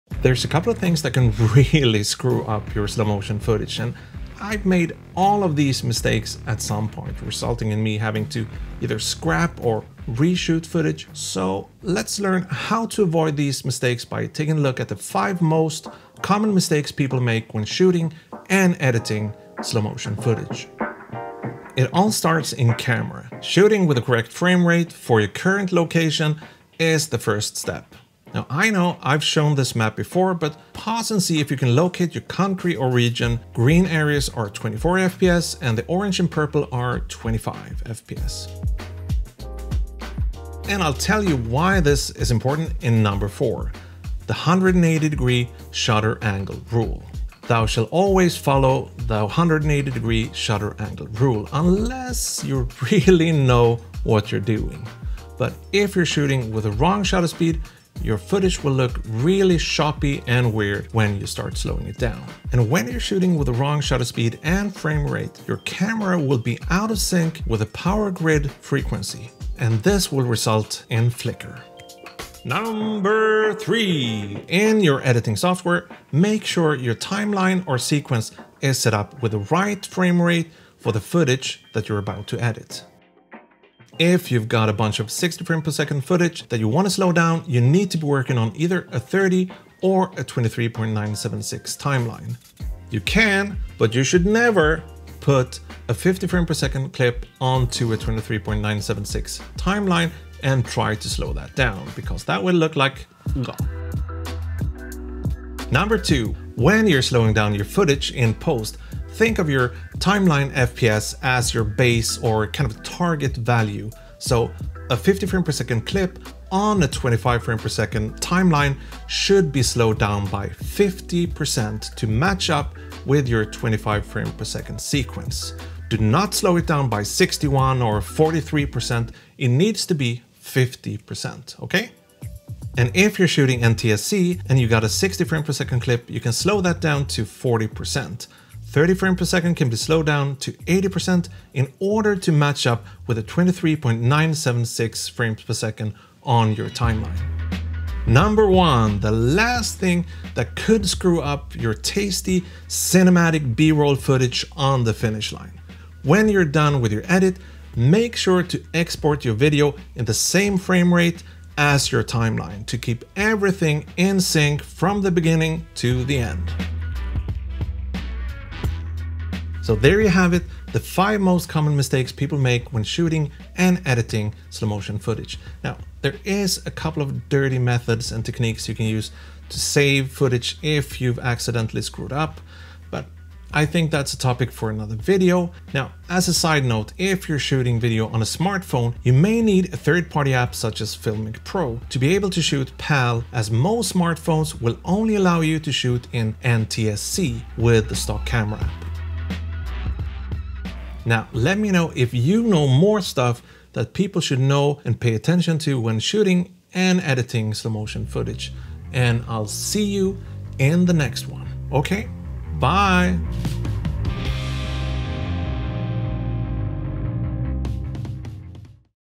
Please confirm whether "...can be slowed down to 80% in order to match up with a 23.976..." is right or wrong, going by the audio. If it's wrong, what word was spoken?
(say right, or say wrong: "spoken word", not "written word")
right.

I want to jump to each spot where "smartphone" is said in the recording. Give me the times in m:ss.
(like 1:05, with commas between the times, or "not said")
3:08, 3:13.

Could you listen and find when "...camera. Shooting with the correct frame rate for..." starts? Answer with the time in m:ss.
0:22.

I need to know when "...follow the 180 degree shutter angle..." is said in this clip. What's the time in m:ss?
0:48.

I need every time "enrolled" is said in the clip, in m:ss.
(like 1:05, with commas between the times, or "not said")
not said.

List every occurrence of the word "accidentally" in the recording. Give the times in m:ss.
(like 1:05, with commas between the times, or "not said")
3:01.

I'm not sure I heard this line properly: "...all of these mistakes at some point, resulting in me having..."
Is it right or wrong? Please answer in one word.
right.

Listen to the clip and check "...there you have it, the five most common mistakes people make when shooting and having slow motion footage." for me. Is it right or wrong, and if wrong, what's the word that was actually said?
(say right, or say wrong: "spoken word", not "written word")
wrong: "editing", not "having".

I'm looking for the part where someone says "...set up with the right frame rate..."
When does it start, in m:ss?
1:18.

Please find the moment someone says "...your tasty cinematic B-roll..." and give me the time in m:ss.
2:31.